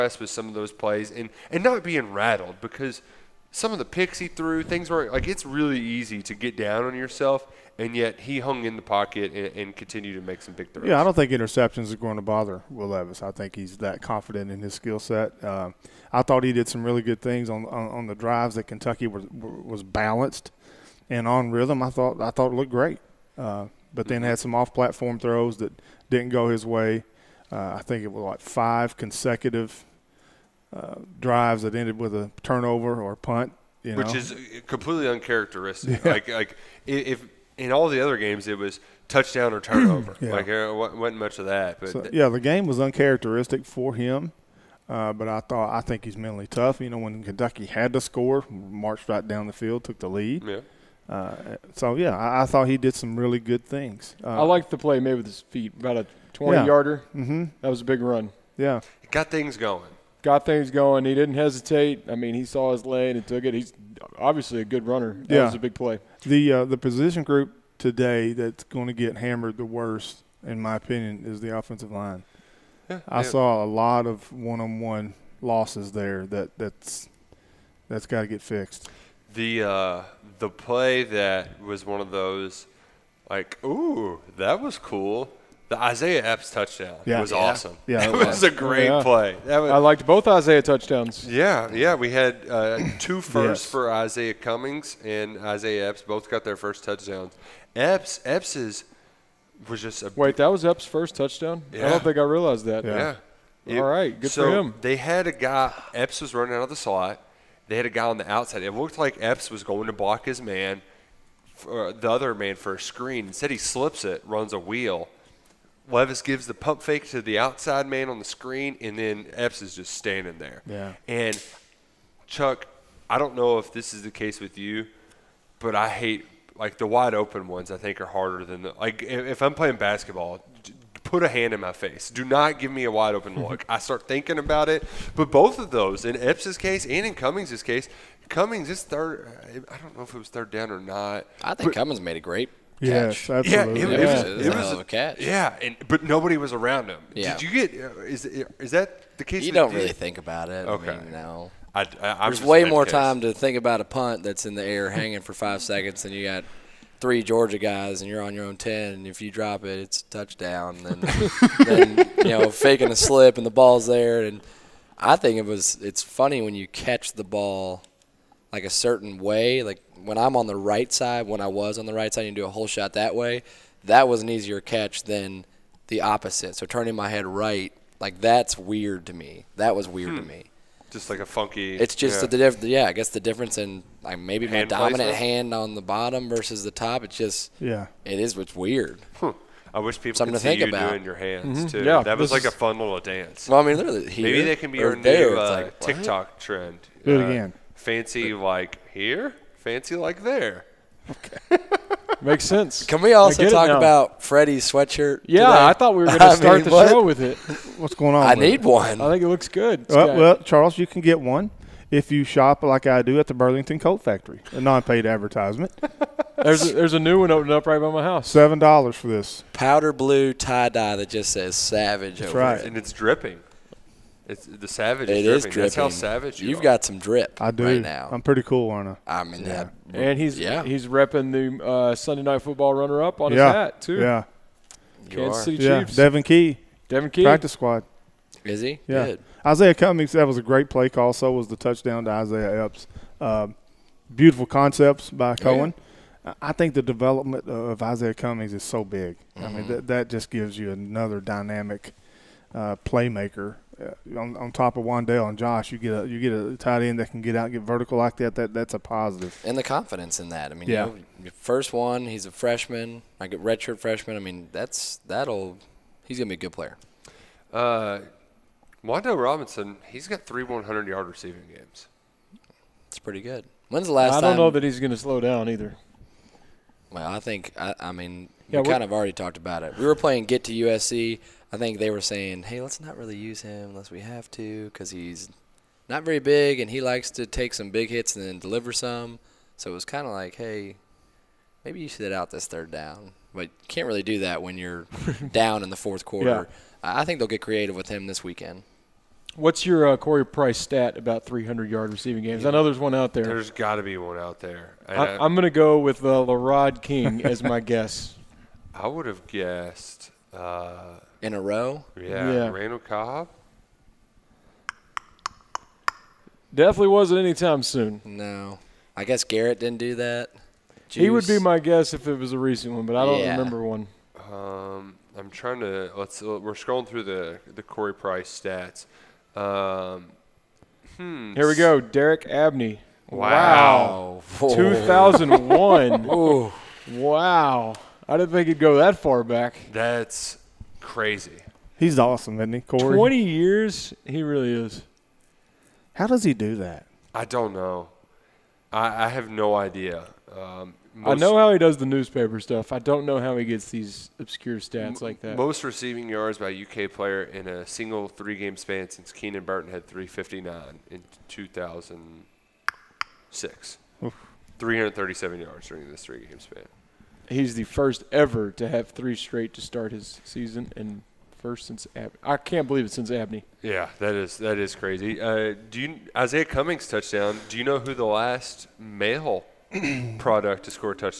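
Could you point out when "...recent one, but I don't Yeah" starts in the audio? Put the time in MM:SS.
05:22.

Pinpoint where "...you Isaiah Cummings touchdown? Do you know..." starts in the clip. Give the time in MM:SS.
06:15.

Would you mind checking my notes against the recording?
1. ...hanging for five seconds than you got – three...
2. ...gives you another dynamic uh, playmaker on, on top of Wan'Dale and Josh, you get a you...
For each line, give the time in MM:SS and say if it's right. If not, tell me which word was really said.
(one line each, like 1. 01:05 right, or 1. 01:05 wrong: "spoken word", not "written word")
1. 02:34 right
2. 04:10 right.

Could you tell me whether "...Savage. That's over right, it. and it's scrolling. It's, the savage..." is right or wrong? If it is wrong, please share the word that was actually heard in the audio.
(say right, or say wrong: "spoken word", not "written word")
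wrong: "dripping", not "scrolling".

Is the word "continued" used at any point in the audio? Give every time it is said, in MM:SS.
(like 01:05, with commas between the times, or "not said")
00:09.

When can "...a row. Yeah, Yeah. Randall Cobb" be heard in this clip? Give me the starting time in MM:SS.
05:11.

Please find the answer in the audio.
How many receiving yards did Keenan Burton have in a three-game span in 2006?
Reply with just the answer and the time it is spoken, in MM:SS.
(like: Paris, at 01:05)
359, at 05:59.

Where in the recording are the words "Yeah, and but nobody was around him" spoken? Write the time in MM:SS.
02:25.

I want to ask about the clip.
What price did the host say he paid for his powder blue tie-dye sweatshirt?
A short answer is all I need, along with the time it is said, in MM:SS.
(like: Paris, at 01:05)
$7, at 03:38.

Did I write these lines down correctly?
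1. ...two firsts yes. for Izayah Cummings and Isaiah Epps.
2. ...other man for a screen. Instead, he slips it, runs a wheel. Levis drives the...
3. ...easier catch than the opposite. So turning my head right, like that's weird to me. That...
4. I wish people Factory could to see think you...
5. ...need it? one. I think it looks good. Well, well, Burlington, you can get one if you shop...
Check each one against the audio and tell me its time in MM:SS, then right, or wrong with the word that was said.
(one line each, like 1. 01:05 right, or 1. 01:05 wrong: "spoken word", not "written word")
1. 01:32 right
2. 01:52 wrong: "gives", not "drives"
3. 02:54 right
4. 03:09 wrong: "Something", not "Factory"
5. 03:28 wrong: "Charles", not "Burlington".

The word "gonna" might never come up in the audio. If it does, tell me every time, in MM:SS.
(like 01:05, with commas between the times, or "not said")
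04:26, 04:34.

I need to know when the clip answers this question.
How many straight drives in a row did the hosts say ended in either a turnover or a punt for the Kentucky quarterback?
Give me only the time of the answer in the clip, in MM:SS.
00:28.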